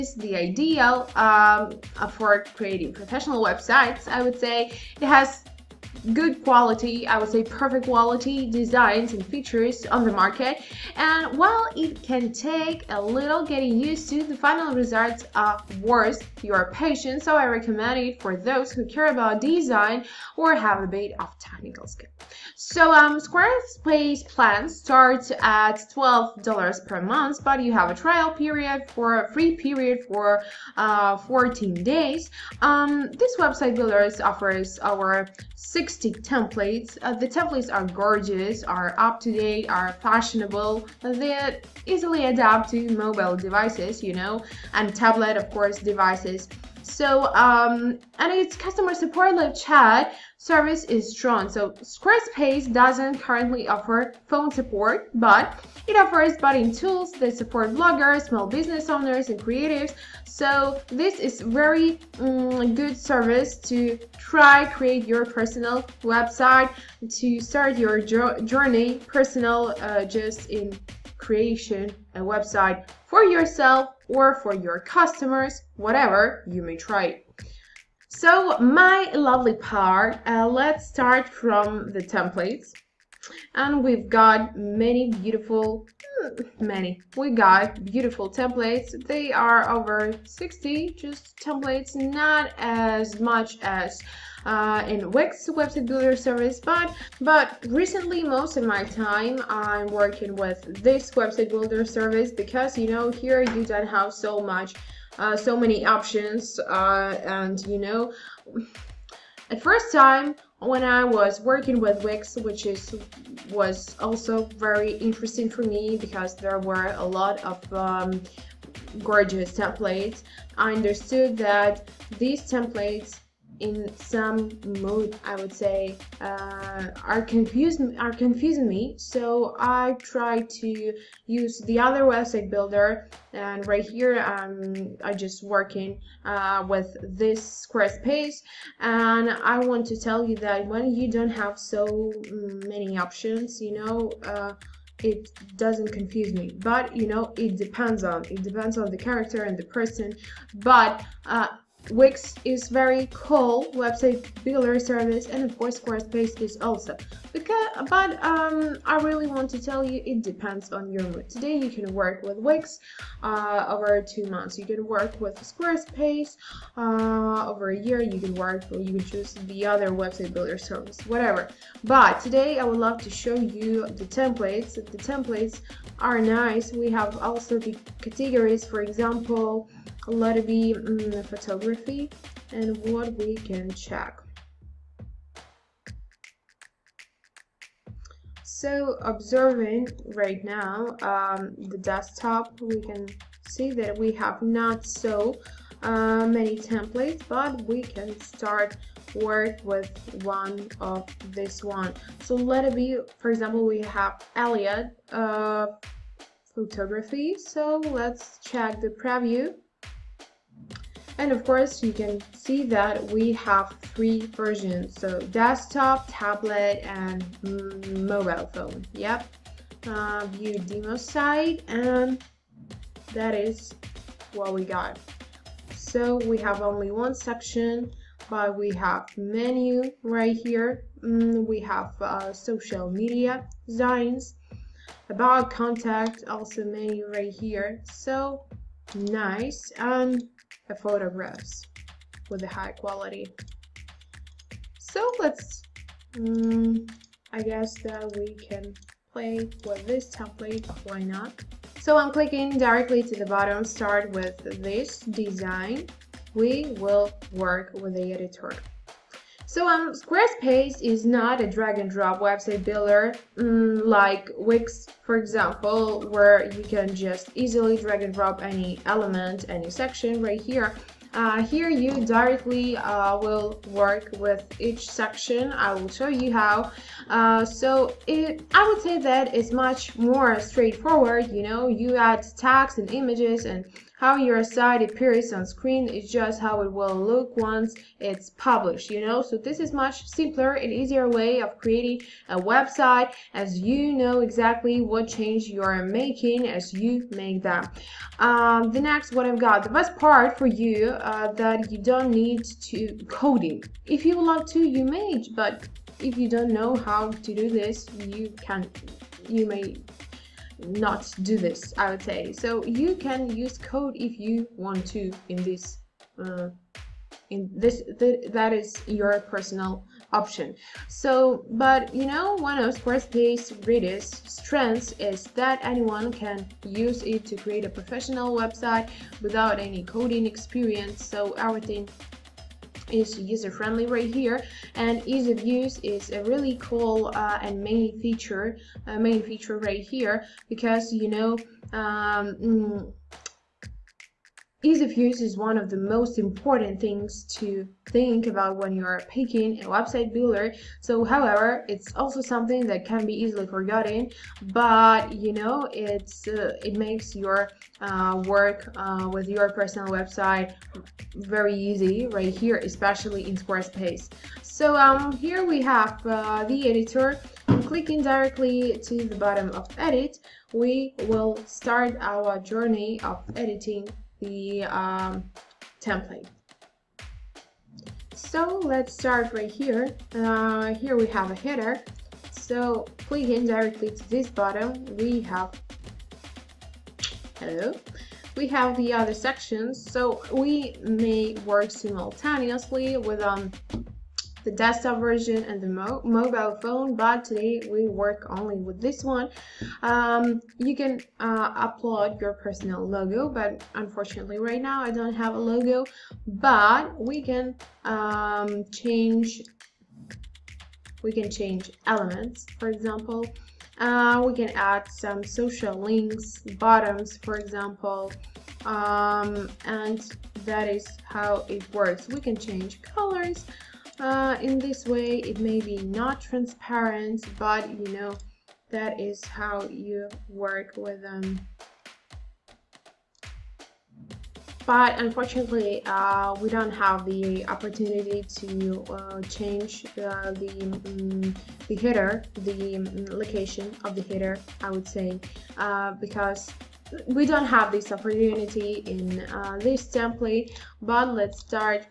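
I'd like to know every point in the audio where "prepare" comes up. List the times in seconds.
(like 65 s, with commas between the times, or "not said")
not said.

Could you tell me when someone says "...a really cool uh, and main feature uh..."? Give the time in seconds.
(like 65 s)
336 s.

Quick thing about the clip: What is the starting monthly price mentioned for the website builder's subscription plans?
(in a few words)
$12.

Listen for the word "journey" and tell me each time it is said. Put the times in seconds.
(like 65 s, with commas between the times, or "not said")
68 s, 372 s.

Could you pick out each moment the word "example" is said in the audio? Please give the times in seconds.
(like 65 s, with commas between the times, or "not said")
178 s, 203 s, 265 s, 412 s, 417 s.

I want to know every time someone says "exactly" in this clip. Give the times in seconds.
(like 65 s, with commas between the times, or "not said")
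294 s.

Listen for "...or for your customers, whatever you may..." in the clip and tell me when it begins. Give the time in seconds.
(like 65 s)
74 s.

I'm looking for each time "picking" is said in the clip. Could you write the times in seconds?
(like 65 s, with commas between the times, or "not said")
349 s.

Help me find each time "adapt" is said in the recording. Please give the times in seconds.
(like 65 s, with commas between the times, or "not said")
42 s.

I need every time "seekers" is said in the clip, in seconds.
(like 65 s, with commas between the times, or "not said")
not said.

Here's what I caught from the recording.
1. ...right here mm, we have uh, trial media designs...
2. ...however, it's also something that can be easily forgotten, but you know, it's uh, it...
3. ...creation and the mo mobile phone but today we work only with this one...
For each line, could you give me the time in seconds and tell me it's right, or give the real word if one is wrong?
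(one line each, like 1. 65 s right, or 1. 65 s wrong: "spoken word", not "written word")
1. 230 s wrong: "social", not "trial"
2. 351 s right
3. 394 s wrong: "version", not "creation".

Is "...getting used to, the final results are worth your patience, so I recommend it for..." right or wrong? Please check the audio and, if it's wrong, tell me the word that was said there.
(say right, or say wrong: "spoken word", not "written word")
right.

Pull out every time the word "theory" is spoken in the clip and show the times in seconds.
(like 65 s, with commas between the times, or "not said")
not said.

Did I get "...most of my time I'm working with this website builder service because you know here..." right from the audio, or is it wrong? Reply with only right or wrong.
right.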